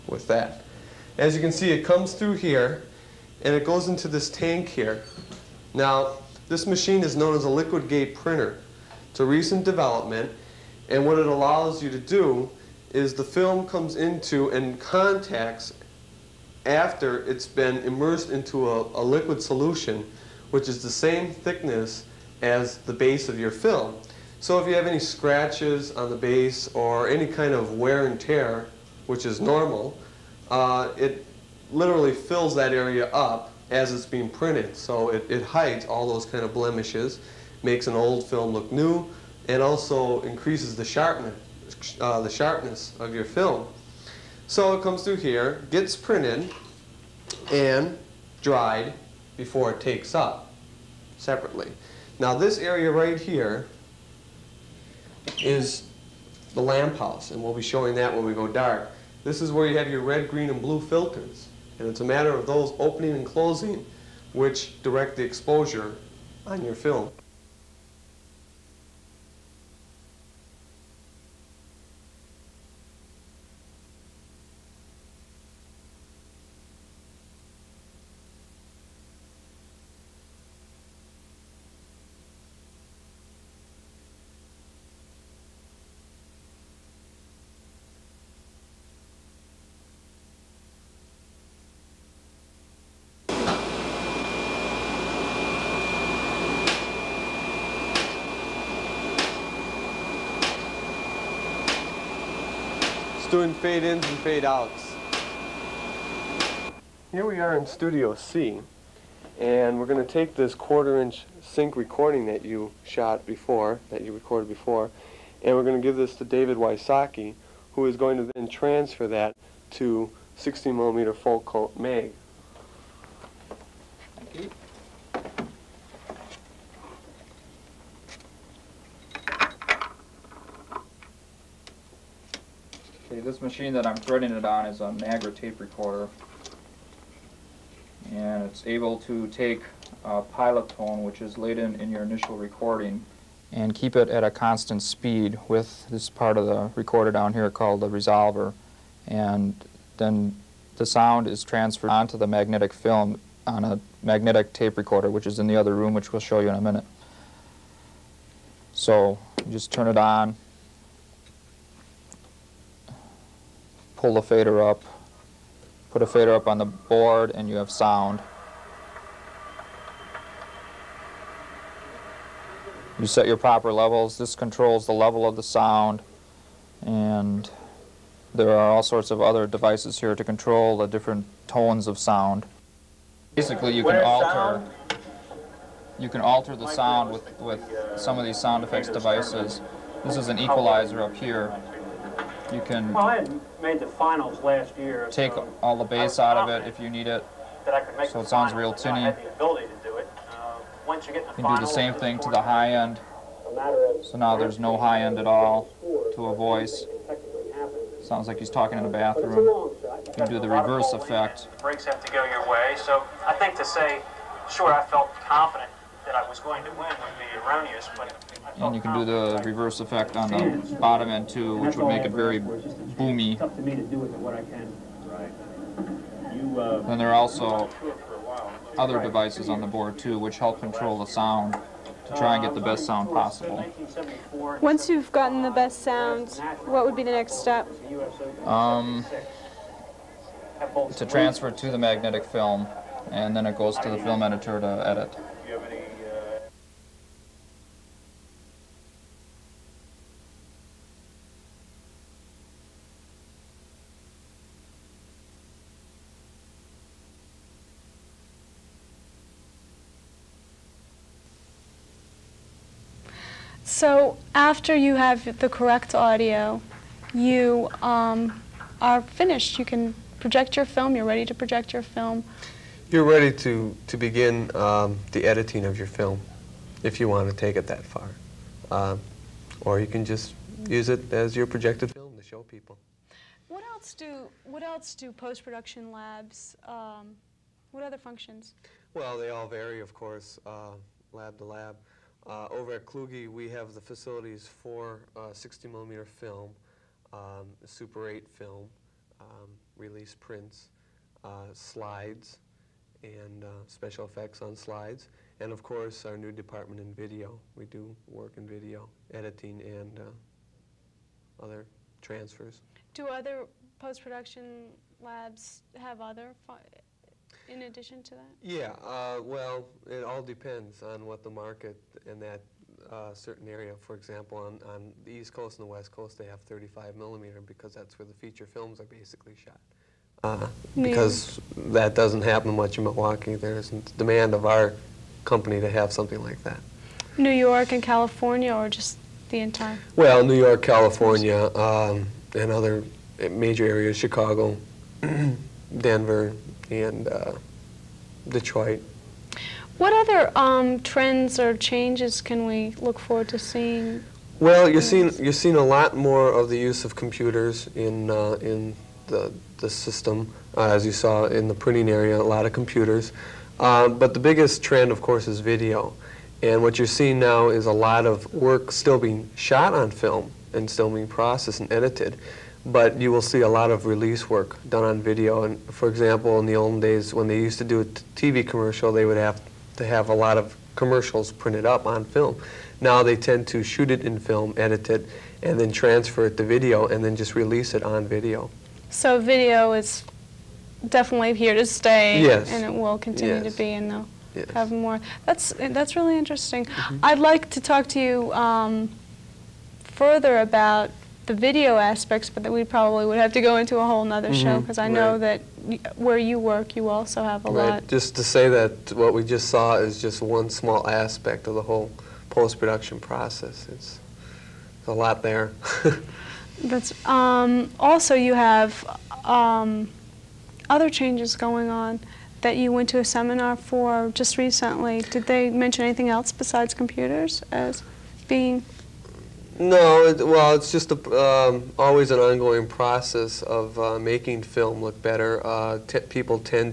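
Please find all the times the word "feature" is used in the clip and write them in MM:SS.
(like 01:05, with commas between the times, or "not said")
05:28.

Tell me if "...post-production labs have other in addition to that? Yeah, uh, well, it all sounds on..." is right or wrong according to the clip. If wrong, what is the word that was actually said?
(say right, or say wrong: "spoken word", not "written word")
wrong: "depends", not "sounds".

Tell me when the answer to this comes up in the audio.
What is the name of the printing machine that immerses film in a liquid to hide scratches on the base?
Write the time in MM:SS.
00:07.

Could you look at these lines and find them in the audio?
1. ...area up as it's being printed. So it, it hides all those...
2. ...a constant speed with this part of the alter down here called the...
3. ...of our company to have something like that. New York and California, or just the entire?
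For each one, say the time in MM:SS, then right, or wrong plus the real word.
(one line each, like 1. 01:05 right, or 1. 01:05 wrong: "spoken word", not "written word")
1. 00:32 right
2. 02:24 wrong: "recorder", not "alter"
3. 05:34 right.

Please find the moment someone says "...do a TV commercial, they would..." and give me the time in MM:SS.
06:17.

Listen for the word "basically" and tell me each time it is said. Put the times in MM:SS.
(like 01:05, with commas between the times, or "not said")
03:03, 05:28.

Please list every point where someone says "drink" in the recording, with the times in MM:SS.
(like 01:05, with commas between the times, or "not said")
not said.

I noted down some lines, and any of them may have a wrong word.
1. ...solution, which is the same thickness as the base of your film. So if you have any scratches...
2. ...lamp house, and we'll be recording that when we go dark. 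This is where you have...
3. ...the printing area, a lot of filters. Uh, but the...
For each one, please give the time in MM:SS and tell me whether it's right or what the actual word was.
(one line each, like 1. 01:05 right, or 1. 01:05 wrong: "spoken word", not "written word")
1. 00:19 right
2. 00:56 wrong: "showing", not "recording"
3. 06:01 wrong: "computers", not "filters".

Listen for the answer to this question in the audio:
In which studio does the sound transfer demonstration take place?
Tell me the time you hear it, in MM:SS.
01:47.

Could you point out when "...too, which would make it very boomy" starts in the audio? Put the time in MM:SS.
03:41.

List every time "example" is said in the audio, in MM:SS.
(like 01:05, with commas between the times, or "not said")
05:23, 06:15.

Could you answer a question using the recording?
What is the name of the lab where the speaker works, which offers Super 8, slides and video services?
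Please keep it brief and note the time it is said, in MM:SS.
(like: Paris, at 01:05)
Kluge, at 04:52.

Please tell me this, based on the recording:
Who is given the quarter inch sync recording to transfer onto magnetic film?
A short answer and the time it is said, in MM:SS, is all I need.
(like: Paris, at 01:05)
David Wysocki, at 01:56.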